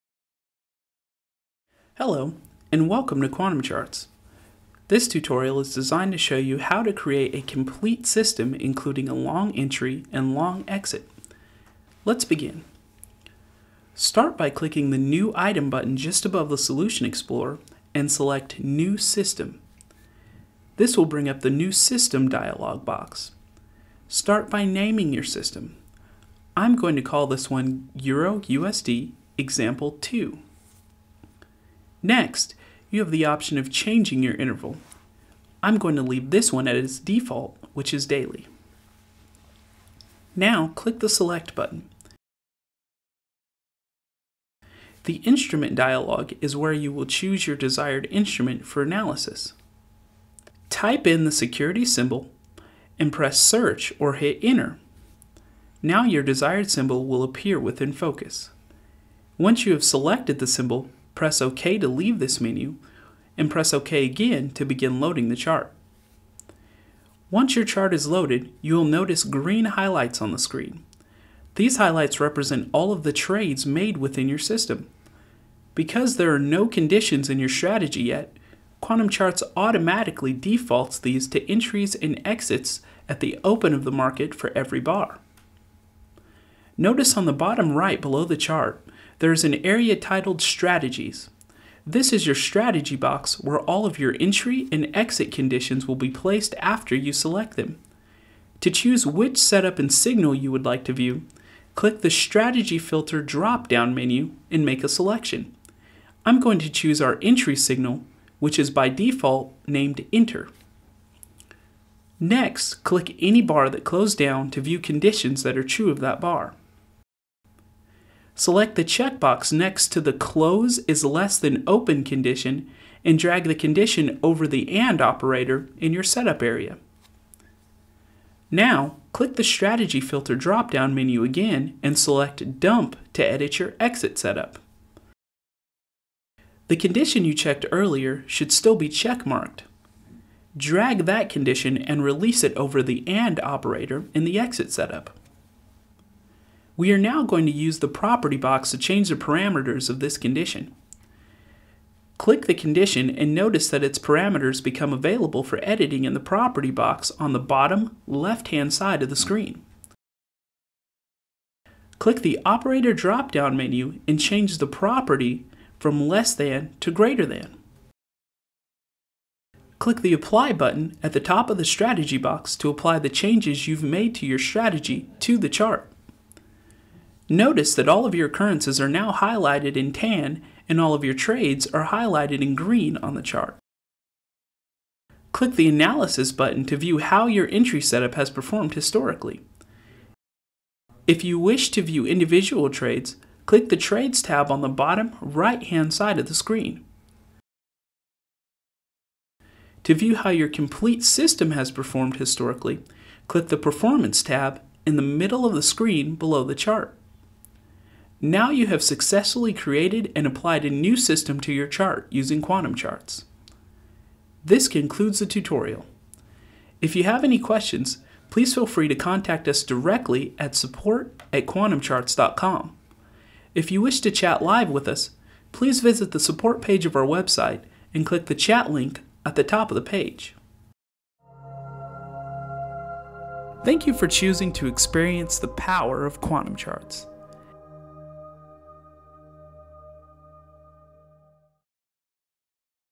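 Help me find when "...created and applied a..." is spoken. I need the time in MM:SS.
03:29.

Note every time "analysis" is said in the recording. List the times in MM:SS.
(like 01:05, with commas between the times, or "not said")
00:48, 03:05.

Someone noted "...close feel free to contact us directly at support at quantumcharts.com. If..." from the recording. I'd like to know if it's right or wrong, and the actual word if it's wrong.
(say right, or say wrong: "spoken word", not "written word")
wrong: "please", not "close".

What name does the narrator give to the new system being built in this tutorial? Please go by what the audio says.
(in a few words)
Euro USD Example 2.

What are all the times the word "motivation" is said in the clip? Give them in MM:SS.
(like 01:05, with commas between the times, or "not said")
not said.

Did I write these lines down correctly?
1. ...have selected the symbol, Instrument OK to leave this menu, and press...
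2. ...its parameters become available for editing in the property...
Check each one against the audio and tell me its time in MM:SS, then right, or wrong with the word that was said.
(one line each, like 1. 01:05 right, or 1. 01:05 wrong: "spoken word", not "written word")
1. 00:59 wrong: "Press", not "Instrument"
2. 02:33 right.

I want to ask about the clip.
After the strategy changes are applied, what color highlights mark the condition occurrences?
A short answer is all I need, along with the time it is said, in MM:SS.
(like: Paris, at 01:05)
Tan, at 02:59.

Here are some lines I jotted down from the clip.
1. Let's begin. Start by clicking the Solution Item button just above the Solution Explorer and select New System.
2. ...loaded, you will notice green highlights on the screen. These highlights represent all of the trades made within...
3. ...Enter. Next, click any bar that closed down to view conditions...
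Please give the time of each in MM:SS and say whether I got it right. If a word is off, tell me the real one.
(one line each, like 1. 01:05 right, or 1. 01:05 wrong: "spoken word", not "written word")
1. 00:12 wrong: "New", not "Solution"
2. 01:08 right
3. 01:50 right.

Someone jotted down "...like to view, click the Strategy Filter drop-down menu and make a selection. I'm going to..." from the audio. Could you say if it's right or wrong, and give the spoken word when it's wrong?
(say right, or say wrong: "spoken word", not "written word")
right.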